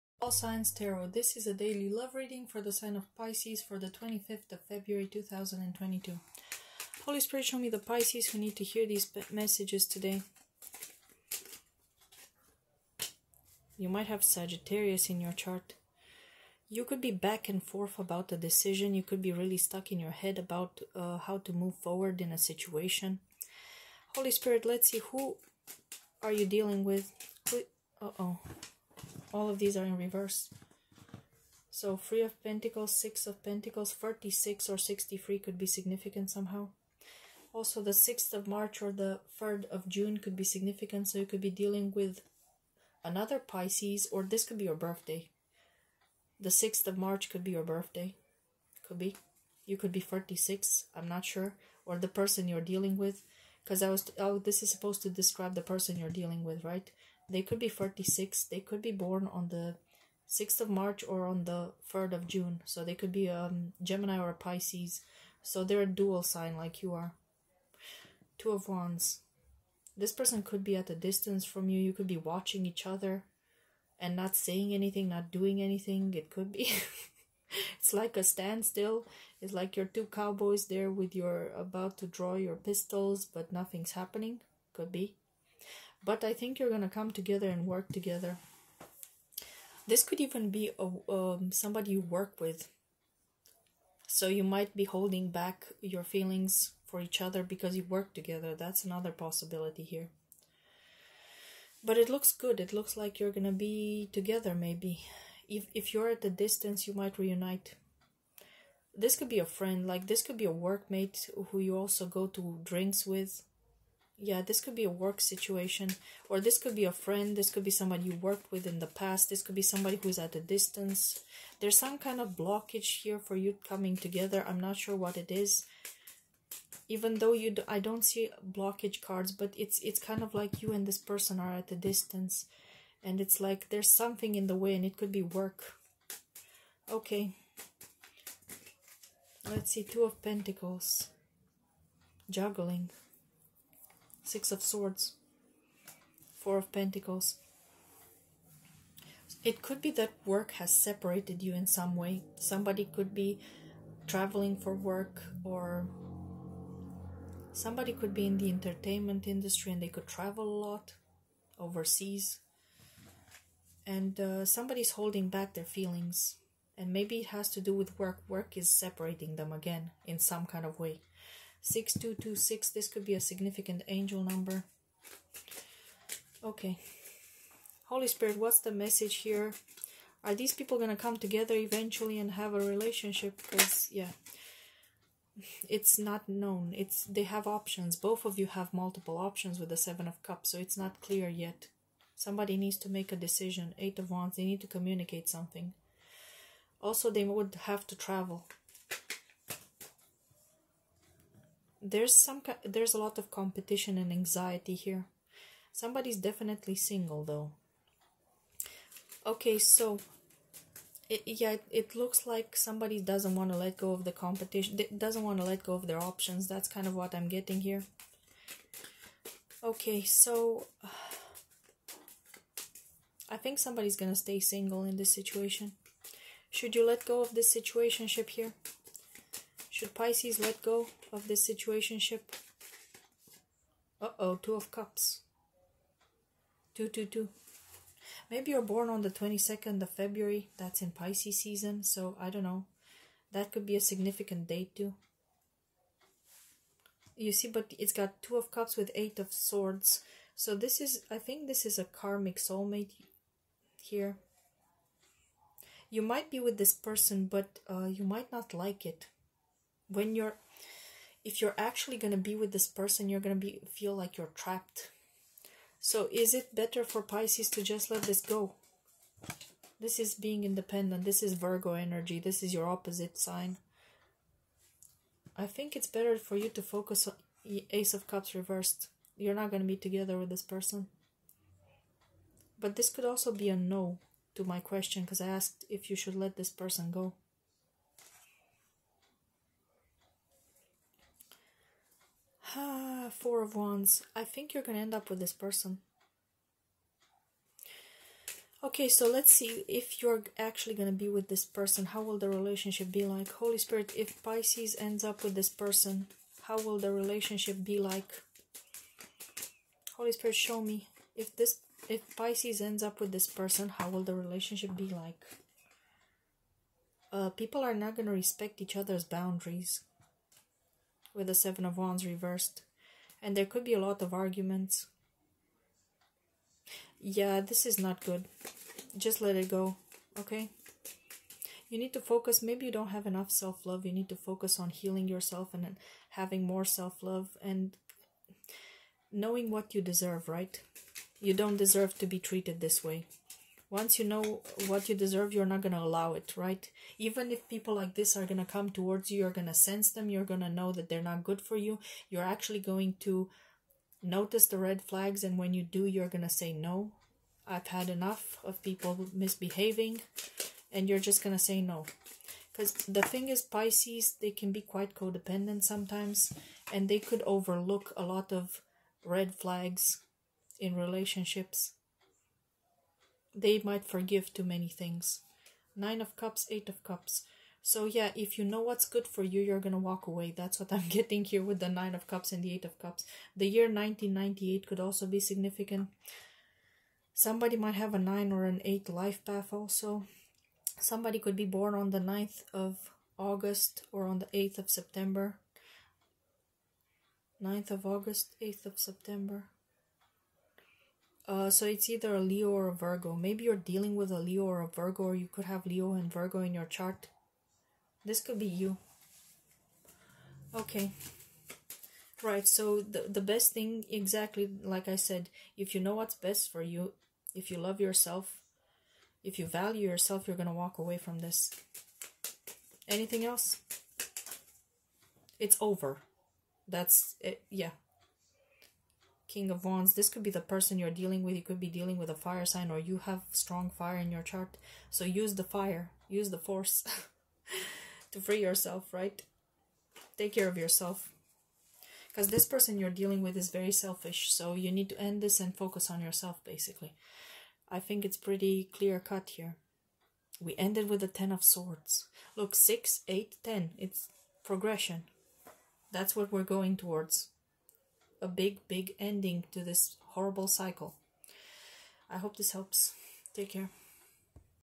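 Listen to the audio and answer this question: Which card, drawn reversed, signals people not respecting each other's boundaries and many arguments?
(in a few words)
Seven of Wands.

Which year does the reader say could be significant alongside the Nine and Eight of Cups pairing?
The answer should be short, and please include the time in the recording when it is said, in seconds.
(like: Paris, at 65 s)
1998, at 383 s.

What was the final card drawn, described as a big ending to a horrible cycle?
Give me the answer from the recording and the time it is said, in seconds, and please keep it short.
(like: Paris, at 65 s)
Ten of Swords, at 451 s.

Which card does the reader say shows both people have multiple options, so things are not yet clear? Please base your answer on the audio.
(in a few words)
Seven of Cups.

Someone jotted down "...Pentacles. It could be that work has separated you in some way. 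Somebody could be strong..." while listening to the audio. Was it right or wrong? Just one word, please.
wrong.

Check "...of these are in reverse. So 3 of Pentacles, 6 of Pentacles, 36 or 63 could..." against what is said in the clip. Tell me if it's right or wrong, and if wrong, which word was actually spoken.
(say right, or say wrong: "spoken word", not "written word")
right.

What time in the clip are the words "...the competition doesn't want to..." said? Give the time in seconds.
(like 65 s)
214 s.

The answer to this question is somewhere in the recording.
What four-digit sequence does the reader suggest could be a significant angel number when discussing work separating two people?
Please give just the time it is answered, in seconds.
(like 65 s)
171 s.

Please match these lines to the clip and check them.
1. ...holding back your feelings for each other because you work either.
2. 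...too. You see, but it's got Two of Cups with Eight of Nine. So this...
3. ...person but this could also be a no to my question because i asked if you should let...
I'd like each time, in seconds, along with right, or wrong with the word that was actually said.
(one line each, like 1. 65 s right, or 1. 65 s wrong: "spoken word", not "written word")
1. 94 s wrong: "together", not "either"
2. 244 s wrong: "Swords", not "Nine"
3. 280 s right.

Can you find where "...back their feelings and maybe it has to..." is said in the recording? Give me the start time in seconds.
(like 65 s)
165 s.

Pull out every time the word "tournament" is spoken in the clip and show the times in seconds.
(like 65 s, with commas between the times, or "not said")
not said.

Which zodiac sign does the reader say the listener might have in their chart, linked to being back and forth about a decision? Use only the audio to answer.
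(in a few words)
Sagittarius.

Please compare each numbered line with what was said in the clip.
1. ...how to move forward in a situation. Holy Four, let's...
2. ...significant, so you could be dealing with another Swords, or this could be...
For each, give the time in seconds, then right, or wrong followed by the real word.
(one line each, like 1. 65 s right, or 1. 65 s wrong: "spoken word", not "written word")
1. 21 s wrong: "Spirit", not "Four"
2. 40 s wrong: "Pisces", not "Swords".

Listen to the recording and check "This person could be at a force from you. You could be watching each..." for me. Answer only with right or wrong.
wrong.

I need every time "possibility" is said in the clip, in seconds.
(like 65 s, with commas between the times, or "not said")
99 s.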